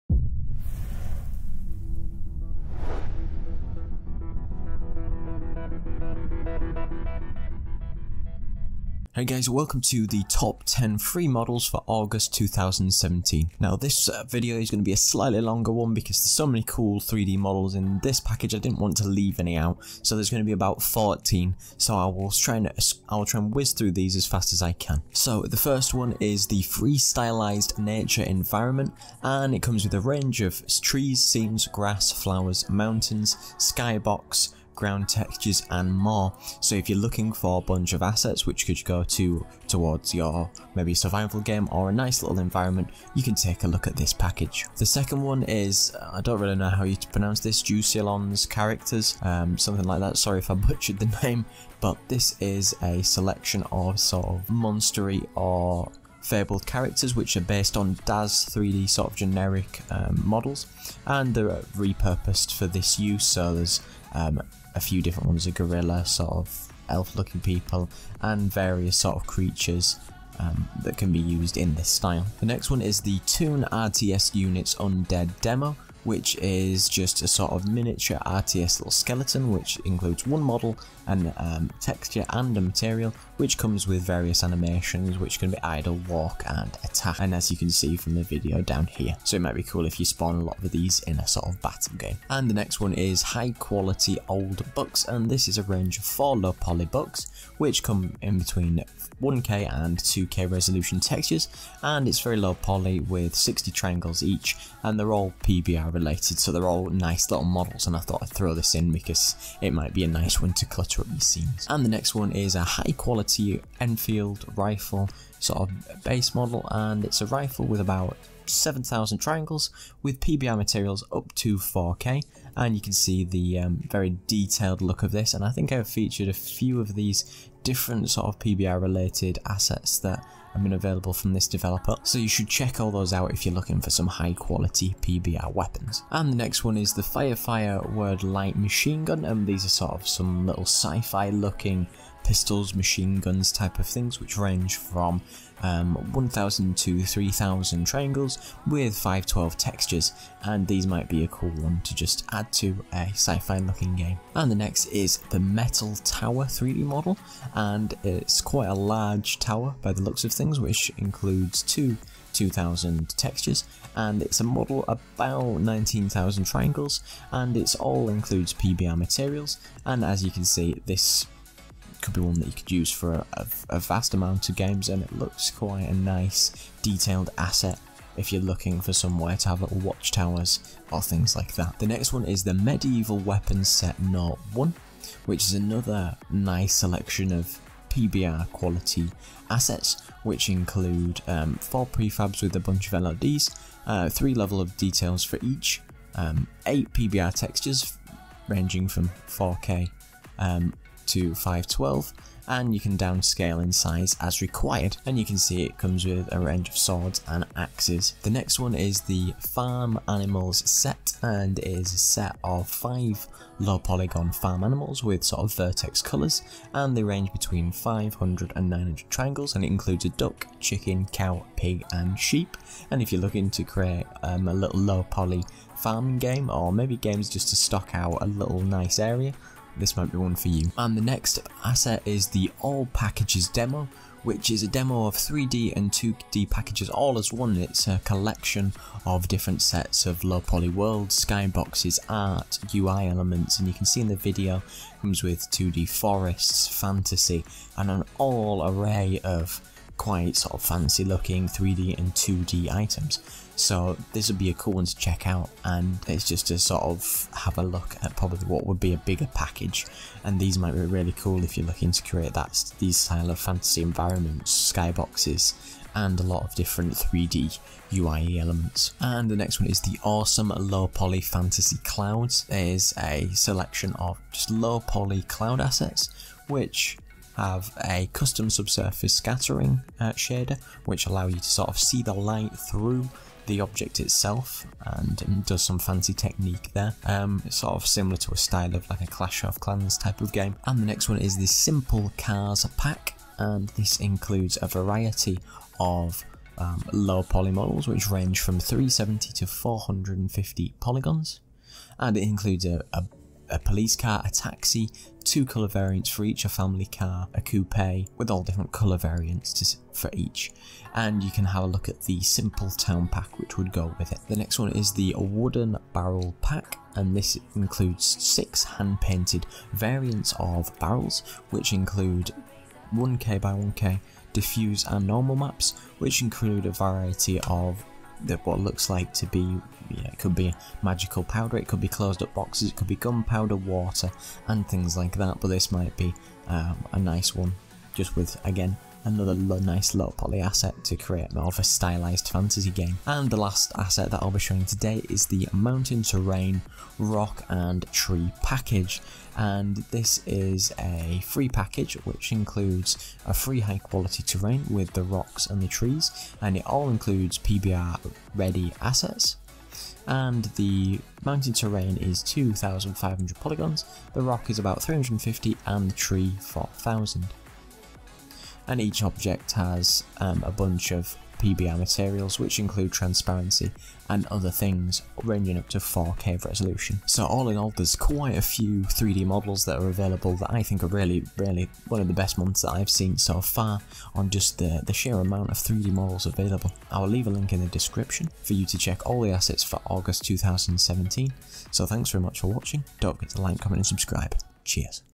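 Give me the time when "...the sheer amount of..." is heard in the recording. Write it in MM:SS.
06:24.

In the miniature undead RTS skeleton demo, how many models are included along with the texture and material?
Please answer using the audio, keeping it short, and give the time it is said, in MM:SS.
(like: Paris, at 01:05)
1, at 01:20.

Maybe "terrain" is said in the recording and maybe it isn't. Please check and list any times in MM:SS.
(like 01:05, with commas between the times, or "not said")
05:46, 05:54, 06:01.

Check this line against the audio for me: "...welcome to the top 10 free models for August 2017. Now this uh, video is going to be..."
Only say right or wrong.
right.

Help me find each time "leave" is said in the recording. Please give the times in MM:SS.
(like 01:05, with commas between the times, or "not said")
00:19, 06:27.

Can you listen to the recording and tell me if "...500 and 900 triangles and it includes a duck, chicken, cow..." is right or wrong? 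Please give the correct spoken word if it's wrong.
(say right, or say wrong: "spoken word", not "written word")
right.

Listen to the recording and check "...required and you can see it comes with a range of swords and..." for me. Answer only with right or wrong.
right.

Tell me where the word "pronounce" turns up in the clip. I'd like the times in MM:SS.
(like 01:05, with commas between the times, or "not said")
00:47.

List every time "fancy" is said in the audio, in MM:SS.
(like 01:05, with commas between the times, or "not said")
04:10, 04:45.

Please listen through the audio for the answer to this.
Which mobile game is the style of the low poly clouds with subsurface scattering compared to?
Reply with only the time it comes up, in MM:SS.
04:49.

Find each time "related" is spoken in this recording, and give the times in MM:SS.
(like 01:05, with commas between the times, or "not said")
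01:45, 02:08.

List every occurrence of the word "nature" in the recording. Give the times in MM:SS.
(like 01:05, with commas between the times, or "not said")
00:27.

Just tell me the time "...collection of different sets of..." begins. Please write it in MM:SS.
03:58.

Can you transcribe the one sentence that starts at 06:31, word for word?
So thanks very much for watching, don't forget to like, comment and subscribe.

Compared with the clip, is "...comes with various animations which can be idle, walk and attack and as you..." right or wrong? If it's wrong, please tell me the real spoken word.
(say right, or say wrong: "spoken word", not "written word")
right.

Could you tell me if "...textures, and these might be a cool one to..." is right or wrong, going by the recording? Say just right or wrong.
right.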